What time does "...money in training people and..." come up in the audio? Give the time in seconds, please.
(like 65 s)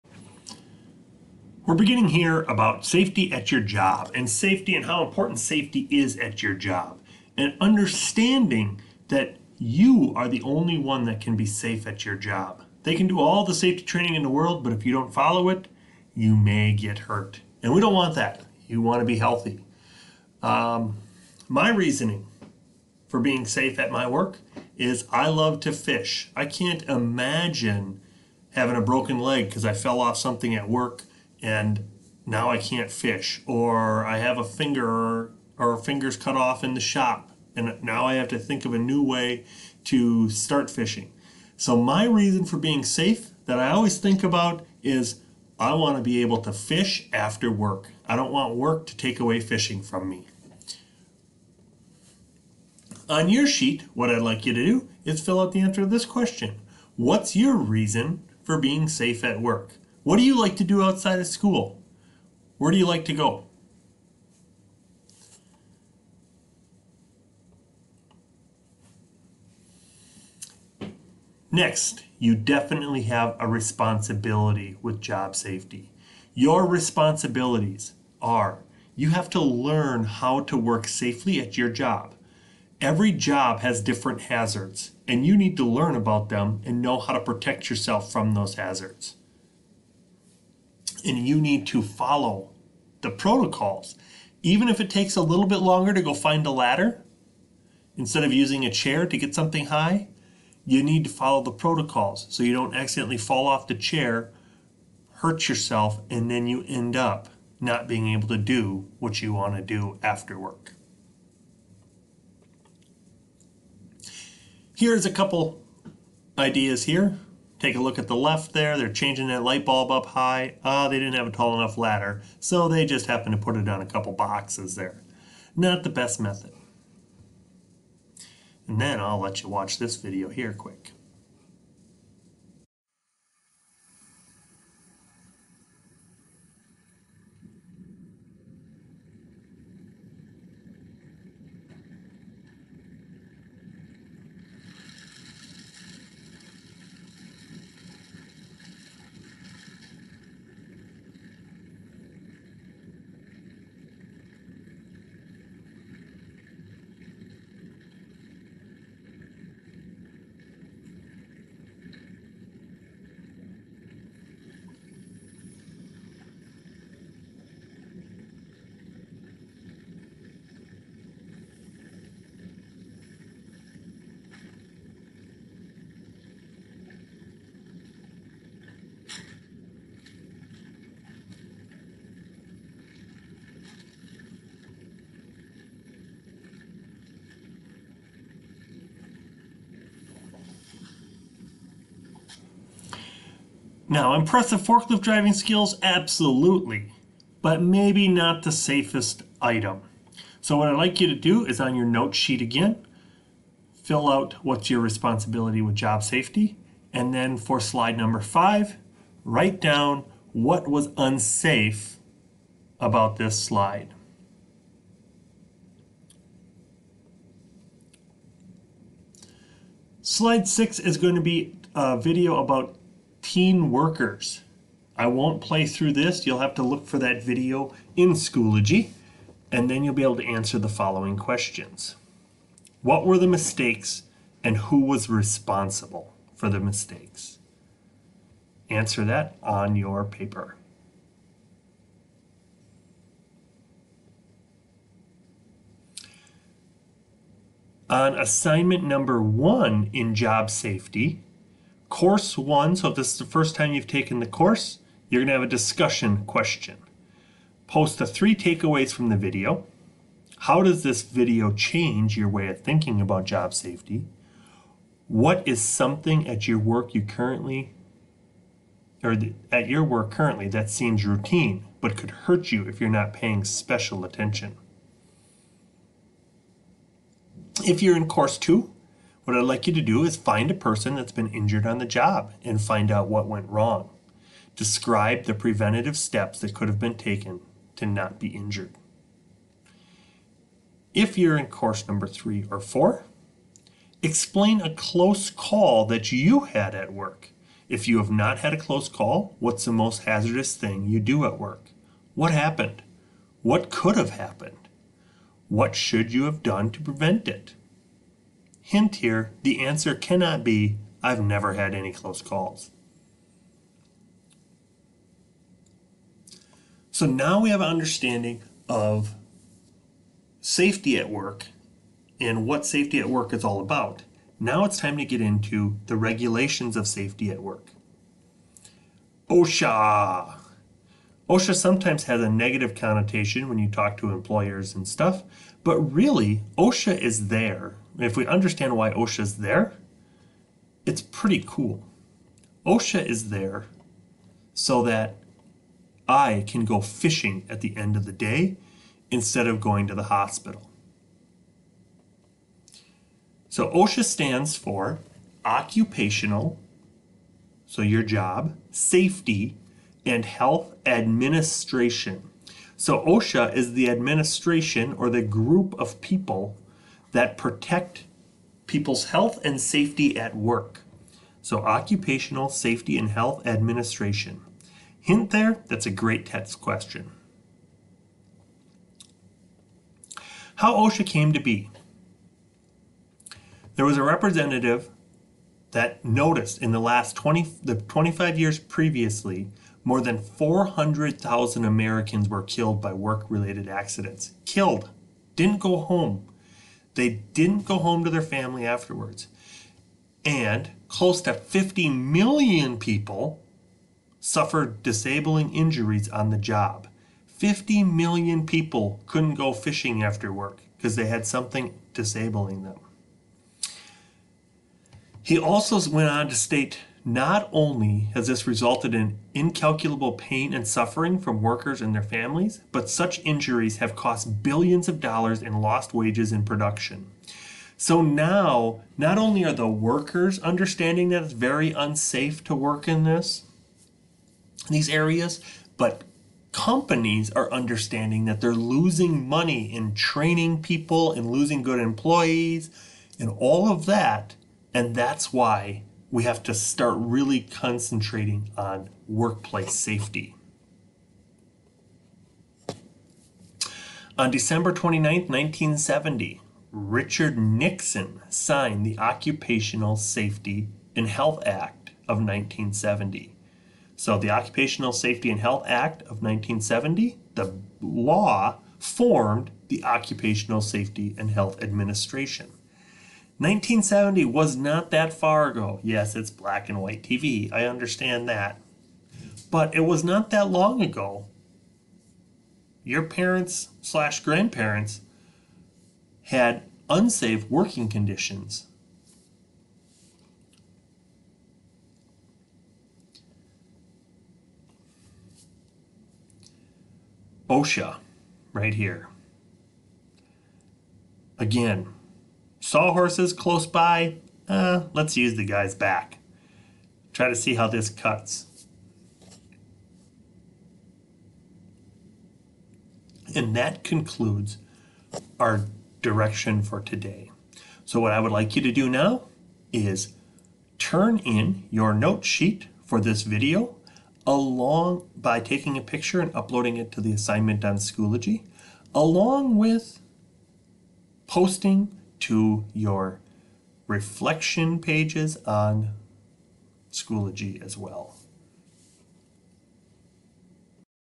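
439 s.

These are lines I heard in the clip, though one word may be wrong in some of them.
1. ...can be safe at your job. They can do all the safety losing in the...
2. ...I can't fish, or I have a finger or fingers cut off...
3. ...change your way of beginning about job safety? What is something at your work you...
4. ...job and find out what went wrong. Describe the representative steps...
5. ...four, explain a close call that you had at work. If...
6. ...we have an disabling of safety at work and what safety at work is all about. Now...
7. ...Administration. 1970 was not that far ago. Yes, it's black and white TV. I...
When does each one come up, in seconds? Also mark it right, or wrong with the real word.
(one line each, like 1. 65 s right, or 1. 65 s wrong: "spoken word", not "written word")
1. 11 s wrong: "training", not "losing"
2. 32 s right
3. 261 s wrong: "thinking", not "beginning"
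4. 281 s wrong: "preventative", not "representative"
5. 292 s right
6. 317 s wrong: "understanding", not "disabling"
7. 471 s right.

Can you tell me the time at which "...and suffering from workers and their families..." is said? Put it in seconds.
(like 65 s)
420 s.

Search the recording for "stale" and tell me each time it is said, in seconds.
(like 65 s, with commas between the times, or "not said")
not said.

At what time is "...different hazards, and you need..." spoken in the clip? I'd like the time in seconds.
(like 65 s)
83 s.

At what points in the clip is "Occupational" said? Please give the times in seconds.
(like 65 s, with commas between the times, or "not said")
355 s, 371 s, 458 s, 464 s, 469 s.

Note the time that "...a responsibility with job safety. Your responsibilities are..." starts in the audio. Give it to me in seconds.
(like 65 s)
73 s.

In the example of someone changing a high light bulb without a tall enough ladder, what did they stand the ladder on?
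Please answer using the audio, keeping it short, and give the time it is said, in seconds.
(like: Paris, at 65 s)
A couple boxes, at 123 s.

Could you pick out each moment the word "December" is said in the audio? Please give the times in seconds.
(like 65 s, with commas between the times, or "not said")
454 s.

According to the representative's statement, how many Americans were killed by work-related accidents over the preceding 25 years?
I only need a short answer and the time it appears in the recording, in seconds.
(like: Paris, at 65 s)
400,000, at 390 s.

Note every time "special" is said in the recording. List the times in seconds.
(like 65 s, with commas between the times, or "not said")
273 s.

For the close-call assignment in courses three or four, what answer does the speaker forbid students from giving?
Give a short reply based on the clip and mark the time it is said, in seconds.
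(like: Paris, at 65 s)
I've never had any close calls, at 311 s.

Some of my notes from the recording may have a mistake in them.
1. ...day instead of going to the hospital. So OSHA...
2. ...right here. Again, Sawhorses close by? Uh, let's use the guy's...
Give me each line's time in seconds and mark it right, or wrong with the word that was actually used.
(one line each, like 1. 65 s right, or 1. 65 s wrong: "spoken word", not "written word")
1. 348 s right
2. 498 s right.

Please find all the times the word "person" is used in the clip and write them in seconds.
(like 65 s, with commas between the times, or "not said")
280 s.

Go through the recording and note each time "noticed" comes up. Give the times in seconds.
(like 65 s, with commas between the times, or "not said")
386 s.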